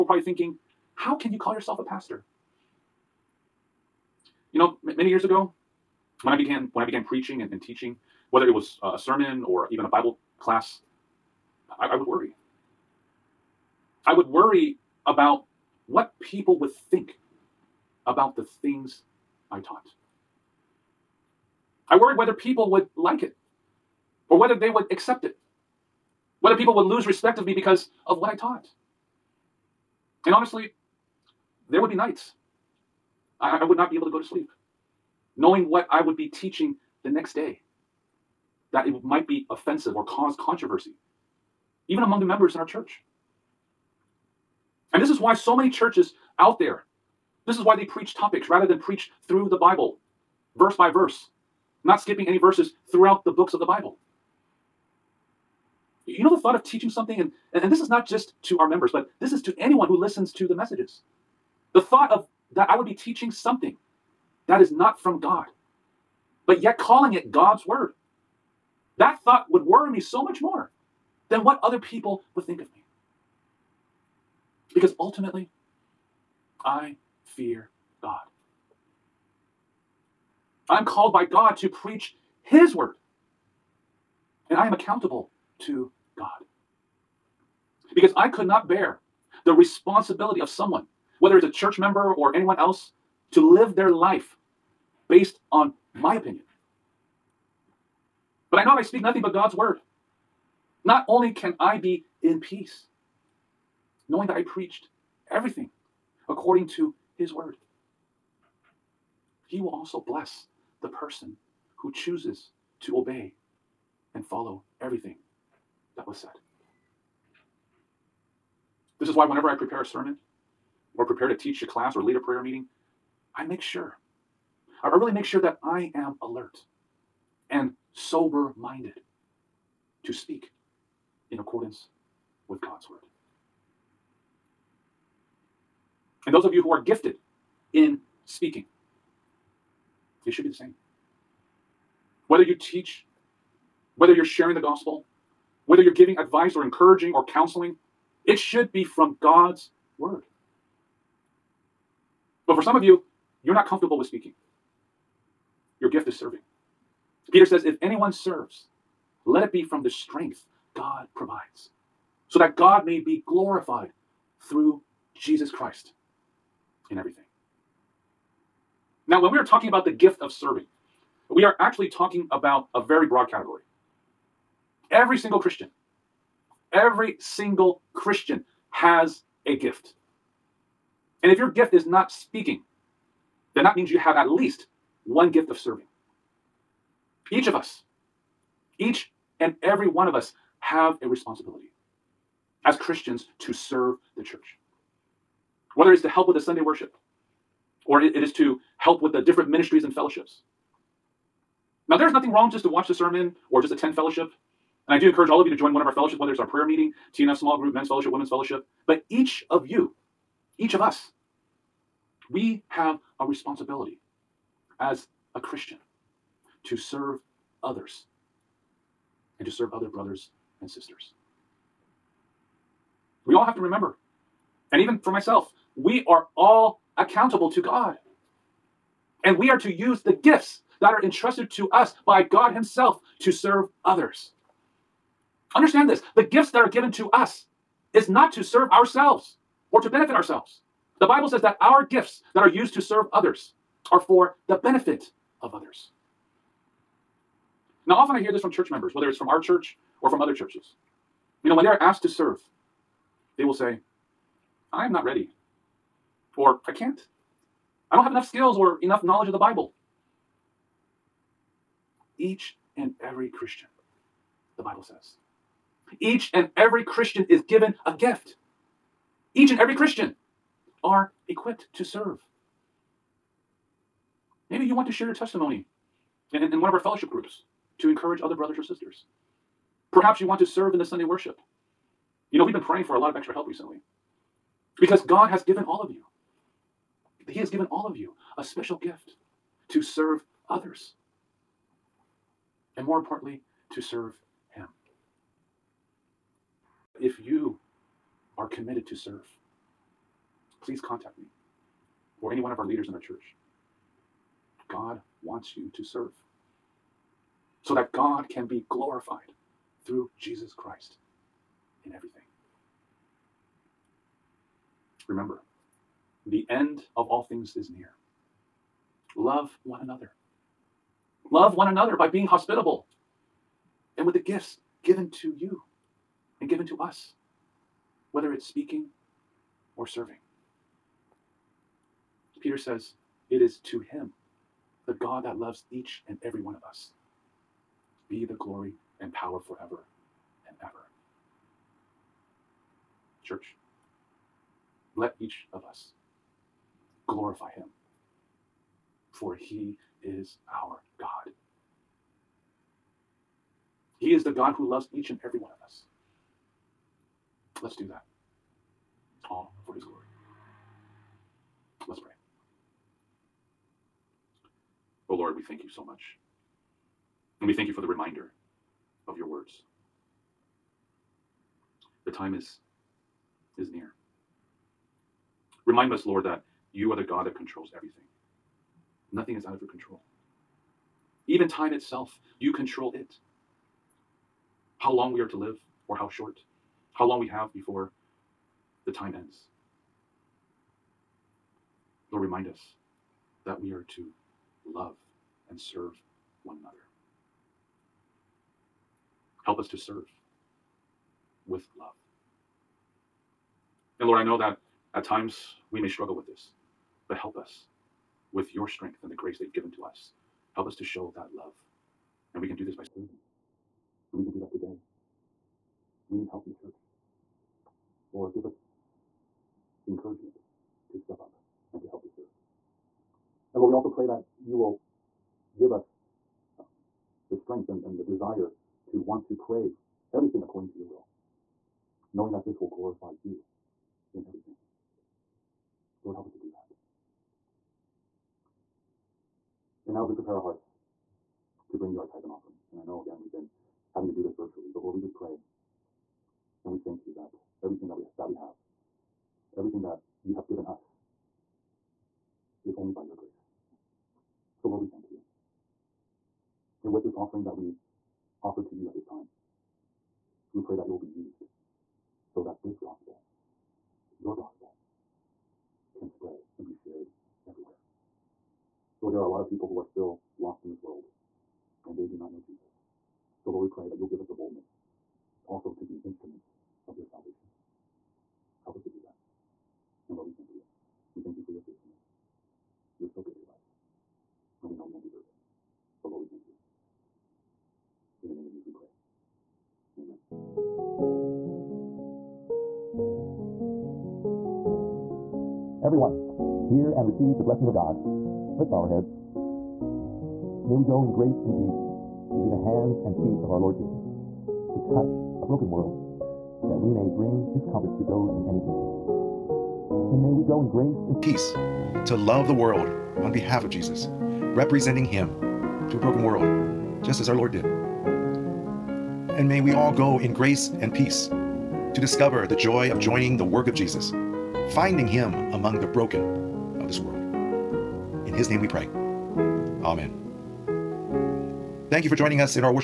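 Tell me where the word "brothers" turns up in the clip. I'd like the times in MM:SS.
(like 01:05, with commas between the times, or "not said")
03:39, 04:38.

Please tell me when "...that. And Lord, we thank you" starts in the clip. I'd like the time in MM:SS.
07:59.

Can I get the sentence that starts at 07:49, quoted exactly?
Lord, there are a lot of people who are still lost in this world and they do not know Jesus.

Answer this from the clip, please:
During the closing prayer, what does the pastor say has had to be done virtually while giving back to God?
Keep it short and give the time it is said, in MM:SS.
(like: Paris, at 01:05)
Tithes and offering, at 07:22.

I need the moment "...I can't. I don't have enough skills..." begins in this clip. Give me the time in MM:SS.
04:16.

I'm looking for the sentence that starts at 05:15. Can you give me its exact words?
Remember, the end of all things is near.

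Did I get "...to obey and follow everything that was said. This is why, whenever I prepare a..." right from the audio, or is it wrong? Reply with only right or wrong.
right.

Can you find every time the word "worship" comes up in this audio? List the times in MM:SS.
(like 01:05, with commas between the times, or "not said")
03:16, 04:41.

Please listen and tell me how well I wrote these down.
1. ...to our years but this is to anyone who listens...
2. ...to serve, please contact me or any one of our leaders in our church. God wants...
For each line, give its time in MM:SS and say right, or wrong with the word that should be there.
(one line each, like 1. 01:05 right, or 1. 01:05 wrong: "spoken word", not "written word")
1. 00:58 wrong: "members", not "years"
2. 04:58 right.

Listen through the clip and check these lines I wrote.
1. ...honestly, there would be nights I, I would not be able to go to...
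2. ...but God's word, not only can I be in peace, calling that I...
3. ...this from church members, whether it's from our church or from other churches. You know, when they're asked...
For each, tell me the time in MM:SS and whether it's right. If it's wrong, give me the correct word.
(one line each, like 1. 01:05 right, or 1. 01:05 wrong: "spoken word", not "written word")
1. 00:30 right
2. 01:39 wrong: "knowing", not "calling"
3. 04:08 right.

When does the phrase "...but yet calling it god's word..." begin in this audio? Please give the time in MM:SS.
01:06.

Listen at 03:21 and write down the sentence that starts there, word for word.
Now, there's nothing wrong just to watch the sermon or just attend fellowship.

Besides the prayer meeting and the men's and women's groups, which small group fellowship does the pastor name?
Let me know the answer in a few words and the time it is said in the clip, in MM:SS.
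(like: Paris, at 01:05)
TNF small group, at 03:27.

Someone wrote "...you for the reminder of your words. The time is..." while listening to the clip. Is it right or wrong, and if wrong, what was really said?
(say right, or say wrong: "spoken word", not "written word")
right.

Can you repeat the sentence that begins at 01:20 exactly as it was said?
I'm called by God to preach His word.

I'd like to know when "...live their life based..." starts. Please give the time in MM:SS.
01:33.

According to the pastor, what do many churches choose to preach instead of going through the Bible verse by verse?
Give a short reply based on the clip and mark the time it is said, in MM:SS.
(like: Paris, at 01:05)
Topics, at 00:48.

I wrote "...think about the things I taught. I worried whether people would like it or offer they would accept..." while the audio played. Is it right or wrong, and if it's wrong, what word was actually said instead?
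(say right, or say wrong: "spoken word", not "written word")
wrong: "whether", not "offer".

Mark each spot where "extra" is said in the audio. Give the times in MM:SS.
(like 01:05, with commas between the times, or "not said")
04:43.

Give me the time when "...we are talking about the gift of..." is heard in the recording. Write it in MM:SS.
02:49.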